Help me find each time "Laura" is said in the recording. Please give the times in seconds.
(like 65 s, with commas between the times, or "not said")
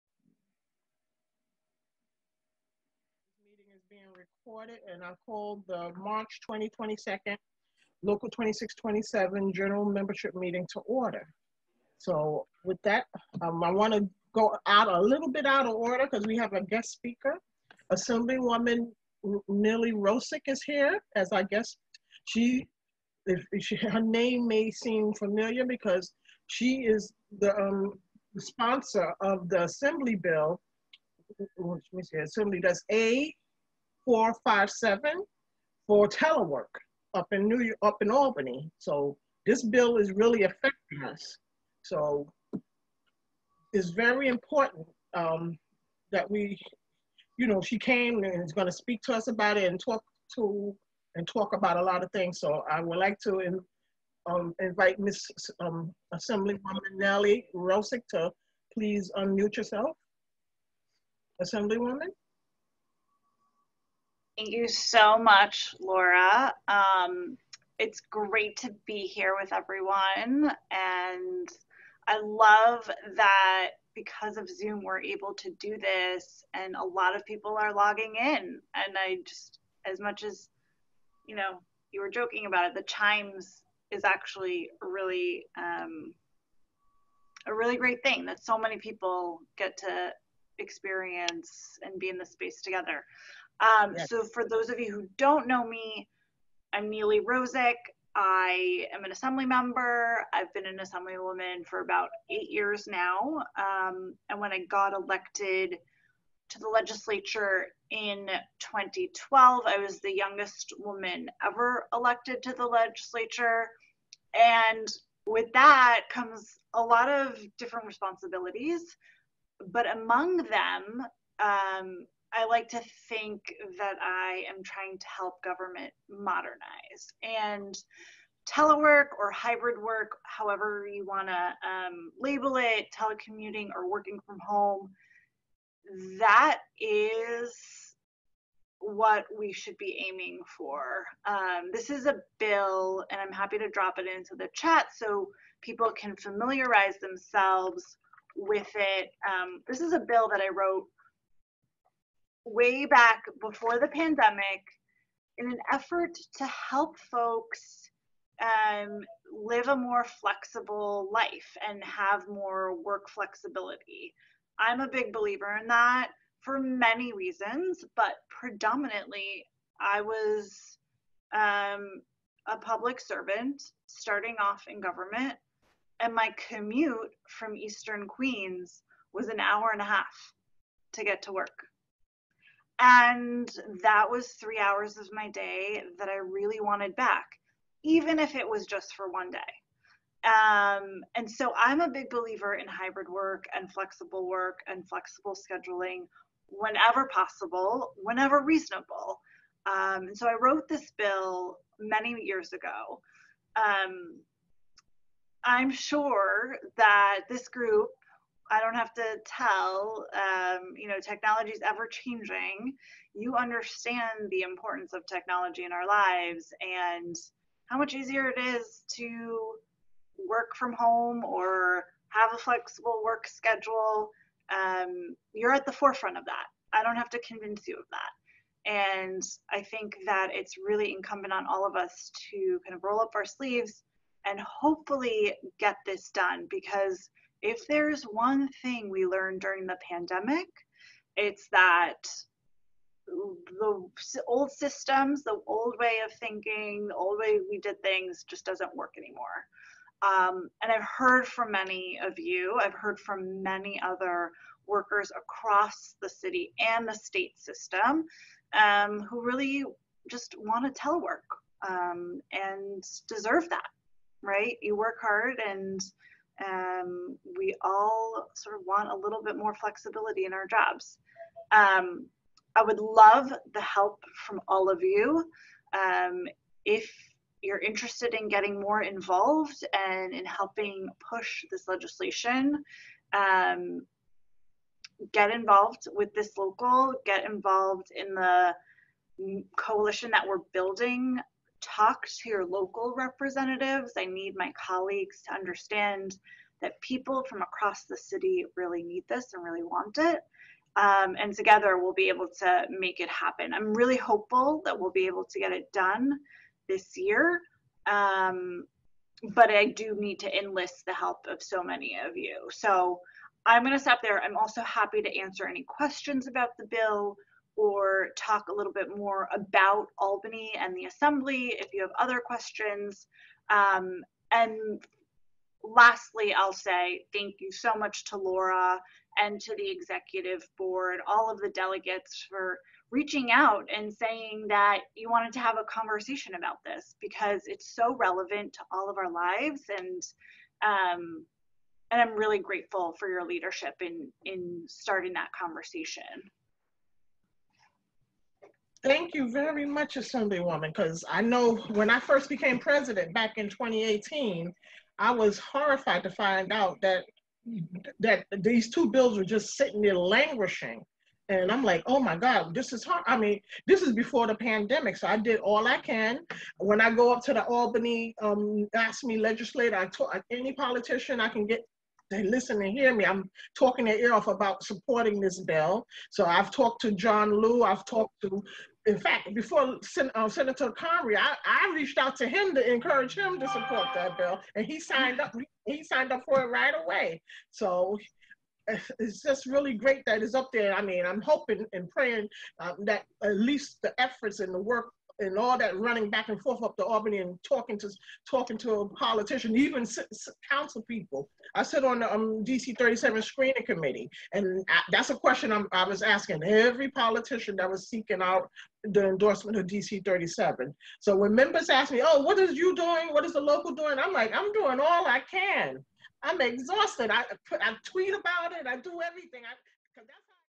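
65 s, 328 s.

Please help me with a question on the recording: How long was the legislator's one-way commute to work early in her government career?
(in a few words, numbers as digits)
An hour and a half.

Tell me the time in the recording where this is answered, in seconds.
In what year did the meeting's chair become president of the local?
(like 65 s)
353 s.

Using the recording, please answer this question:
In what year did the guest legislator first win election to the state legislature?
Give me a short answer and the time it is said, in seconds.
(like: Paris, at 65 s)
2012, at 108 s.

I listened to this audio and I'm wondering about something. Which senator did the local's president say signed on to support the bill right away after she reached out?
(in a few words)
Senator Comrie.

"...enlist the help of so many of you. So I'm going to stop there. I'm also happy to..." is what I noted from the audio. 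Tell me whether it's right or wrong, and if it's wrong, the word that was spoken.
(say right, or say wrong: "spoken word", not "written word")
right.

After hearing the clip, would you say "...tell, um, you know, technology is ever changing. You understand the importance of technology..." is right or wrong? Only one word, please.
right.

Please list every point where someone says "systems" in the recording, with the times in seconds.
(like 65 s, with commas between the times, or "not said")
244 s, 257 s.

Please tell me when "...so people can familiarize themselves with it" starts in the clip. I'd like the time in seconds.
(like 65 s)
144 s.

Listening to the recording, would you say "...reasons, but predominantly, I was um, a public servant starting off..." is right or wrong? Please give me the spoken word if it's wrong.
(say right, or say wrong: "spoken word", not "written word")
right.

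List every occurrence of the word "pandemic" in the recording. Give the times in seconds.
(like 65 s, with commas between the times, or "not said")
153 s, 239 s, 364 s.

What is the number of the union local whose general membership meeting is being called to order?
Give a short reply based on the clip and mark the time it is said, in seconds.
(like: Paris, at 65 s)
2627, at 8 s.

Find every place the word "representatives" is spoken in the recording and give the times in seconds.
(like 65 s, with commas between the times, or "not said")
292 s.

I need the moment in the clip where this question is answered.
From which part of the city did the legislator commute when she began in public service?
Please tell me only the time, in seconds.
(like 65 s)
177 s.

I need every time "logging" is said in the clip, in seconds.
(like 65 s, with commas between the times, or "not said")
77 s.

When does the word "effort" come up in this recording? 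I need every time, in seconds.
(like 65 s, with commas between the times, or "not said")
155 s, 394 s.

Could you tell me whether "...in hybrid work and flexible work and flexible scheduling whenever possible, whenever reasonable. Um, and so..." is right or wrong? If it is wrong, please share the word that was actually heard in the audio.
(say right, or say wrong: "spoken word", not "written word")
right.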